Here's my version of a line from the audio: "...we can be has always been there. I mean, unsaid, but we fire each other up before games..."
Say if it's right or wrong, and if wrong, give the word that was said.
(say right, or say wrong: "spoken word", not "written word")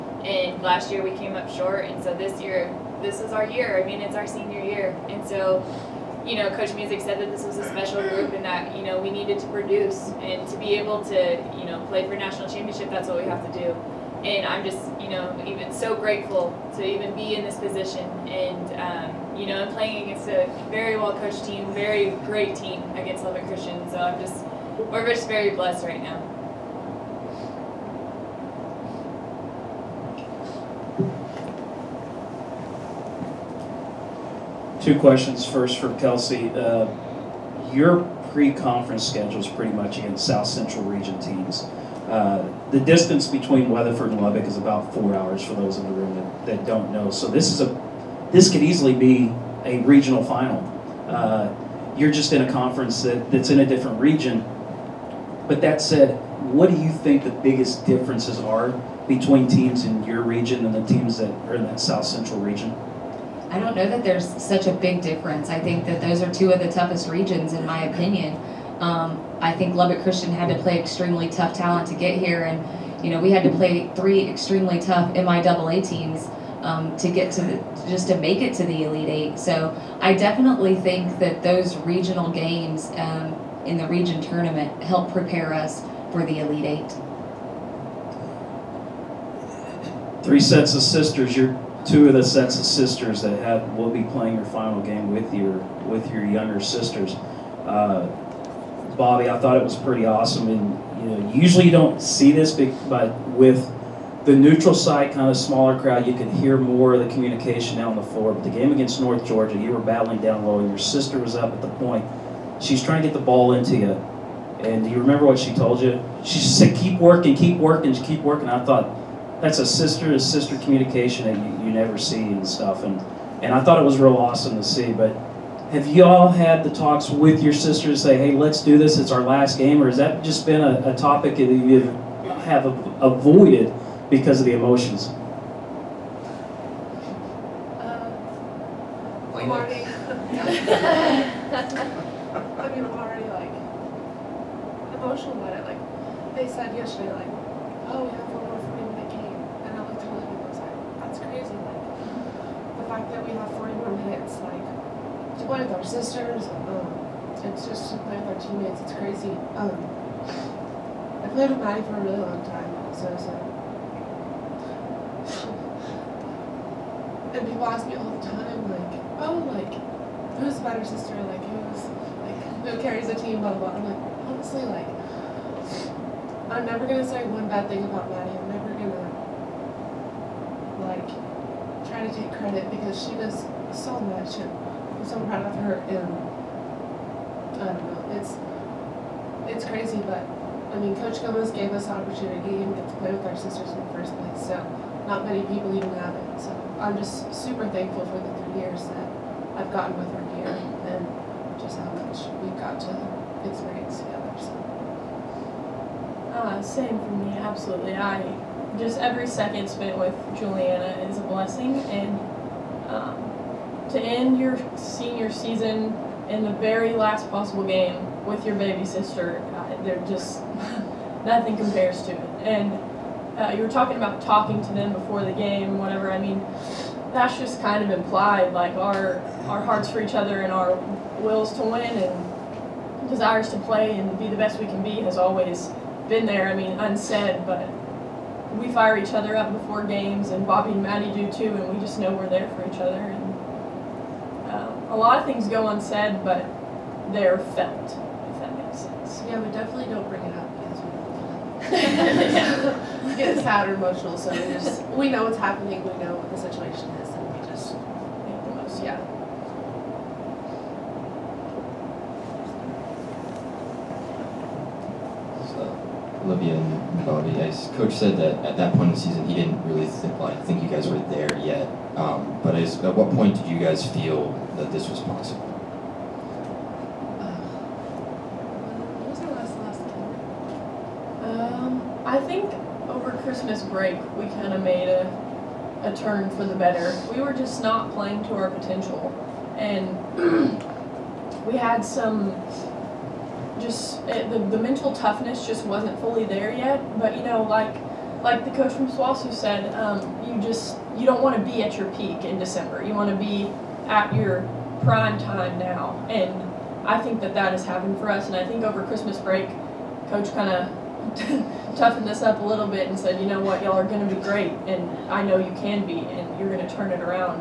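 right.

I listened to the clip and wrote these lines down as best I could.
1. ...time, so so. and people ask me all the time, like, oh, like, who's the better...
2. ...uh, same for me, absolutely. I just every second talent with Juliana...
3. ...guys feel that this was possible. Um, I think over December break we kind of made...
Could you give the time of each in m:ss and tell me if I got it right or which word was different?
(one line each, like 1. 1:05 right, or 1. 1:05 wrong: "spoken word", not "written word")
1. 2:42 right
2. 3:26 wrong: "spent", not "talent"
3. 4:33 wrong: "Christmas", not "December".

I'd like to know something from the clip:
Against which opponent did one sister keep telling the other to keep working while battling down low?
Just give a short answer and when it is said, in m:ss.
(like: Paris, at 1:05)
North Georgia, at 1:49.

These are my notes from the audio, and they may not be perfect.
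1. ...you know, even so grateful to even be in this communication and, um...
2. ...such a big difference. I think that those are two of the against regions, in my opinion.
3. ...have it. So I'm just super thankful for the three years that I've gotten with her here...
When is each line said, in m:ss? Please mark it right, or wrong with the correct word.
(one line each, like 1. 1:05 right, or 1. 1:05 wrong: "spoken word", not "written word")
1. 0:15 wrong: "position", not "communication"
2. 1:04 wrong: "toughest", not "against"
3. 3:15 right.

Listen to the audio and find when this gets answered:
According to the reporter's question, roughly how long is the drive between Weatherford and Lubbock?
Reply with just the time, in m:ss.
0:44.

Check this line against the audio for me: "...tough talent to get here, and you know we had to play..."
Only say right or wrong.
right.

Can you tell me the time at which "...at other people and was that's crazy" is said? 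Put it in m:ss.
2:30.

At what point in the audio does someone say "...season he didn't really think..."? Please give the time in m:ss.
4:28.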